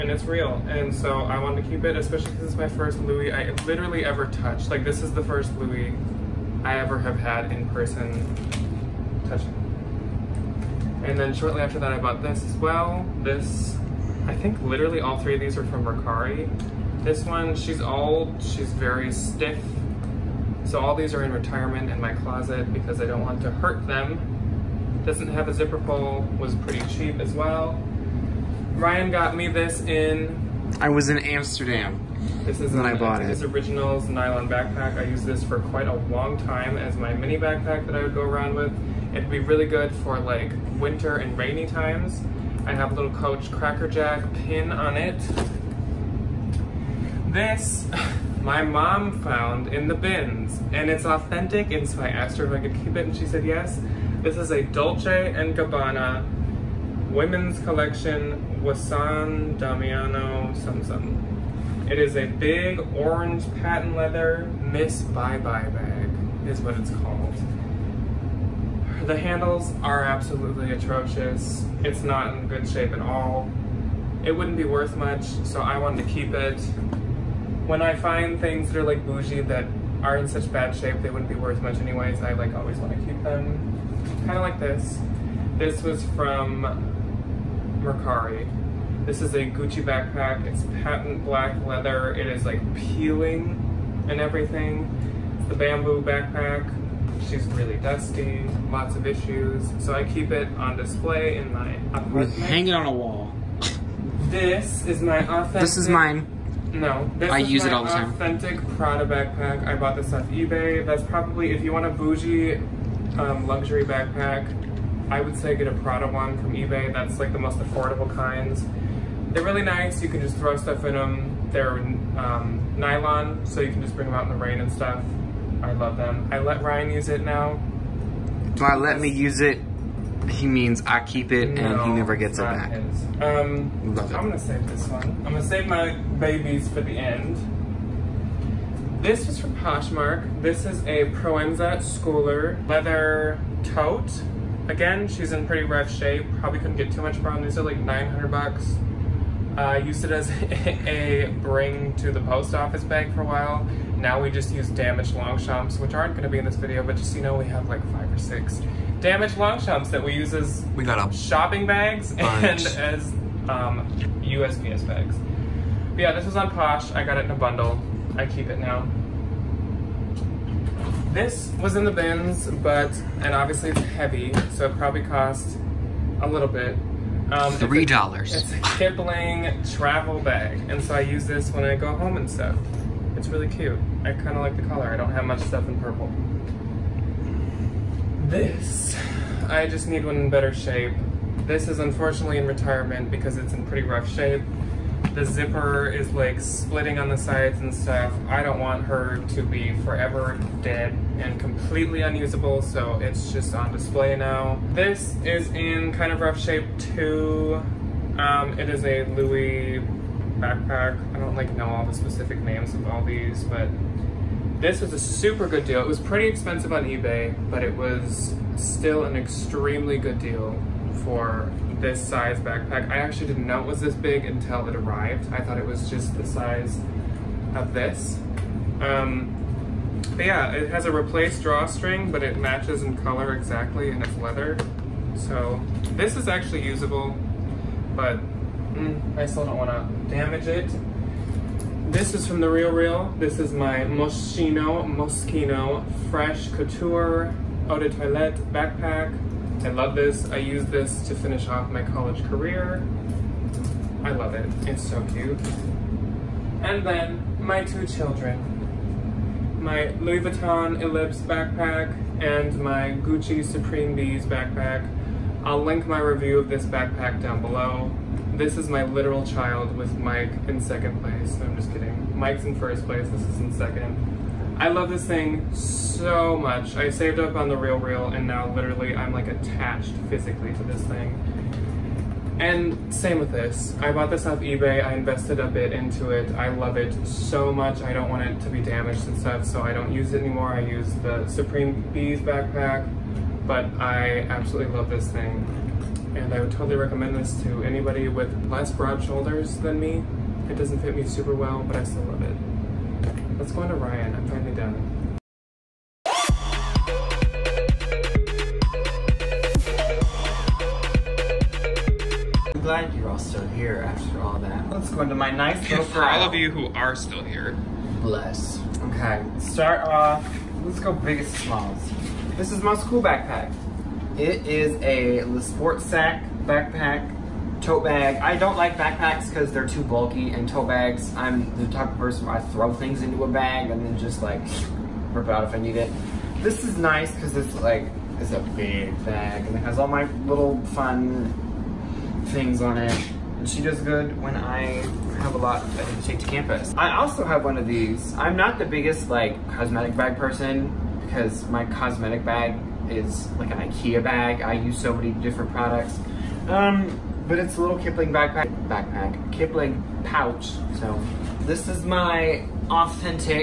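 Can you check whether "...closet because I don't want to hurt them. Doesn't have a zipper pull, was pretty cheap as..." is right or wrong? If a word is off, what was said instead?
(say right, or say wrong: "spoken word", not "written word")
right.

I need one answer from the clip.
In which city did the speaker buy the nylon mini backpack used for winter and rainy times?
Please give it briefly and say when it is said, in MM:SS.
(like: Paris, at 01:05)
Amsterdam, at 00:31.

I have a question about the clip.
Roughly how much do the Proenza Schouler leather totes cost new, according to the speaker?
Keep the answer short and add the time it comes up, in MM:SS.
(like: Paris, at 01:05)
$900, at 02:27.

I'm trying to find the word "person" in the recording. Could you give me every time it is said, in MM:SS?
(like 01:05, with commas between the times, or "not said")
00:07, 05:31, 05:50.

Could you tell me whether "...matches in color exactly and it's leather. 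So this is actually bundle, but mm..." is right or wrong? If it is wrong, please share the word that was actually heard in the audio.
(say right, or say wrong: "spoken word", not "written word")
wrong: "usable", not "bundle".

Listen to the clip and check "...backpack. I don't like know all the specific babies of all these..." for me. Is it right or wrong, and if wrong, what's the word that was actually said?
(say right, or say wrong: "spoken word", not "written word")
wrong: "names", not "babies".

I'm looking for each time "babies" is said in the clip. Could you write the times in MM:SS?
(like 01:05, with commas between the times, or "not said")
02:15.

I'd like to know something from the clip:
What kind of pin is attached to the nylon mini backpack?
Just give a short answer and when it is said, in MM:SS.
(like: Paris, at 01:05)
Coach Cracker Jack pin, at 00:43.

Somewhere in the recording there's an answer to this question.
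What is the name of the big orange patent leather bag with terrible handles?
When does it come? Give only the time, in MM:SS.
01:04.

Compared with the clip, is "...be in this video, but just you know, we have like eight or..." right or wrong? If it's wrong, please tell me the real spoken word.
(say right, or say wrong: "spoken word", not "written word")
wrong: "five", not "eight".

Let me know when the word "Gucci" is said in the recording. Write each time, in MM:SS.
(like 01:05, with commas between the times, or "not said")
01:29, 04:23.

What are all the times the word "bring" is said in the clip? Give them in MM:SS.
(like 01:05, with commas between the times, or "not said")
02:03, 02:31.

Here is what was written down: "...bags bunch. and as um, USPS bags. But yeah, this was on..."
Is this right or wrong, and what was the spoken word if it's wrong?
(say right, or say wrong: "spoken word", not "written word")
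right.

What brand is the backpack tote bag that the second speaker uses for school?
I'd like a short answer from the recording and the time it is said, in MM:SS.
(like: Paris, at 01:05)
LeSportsac, at 05:25.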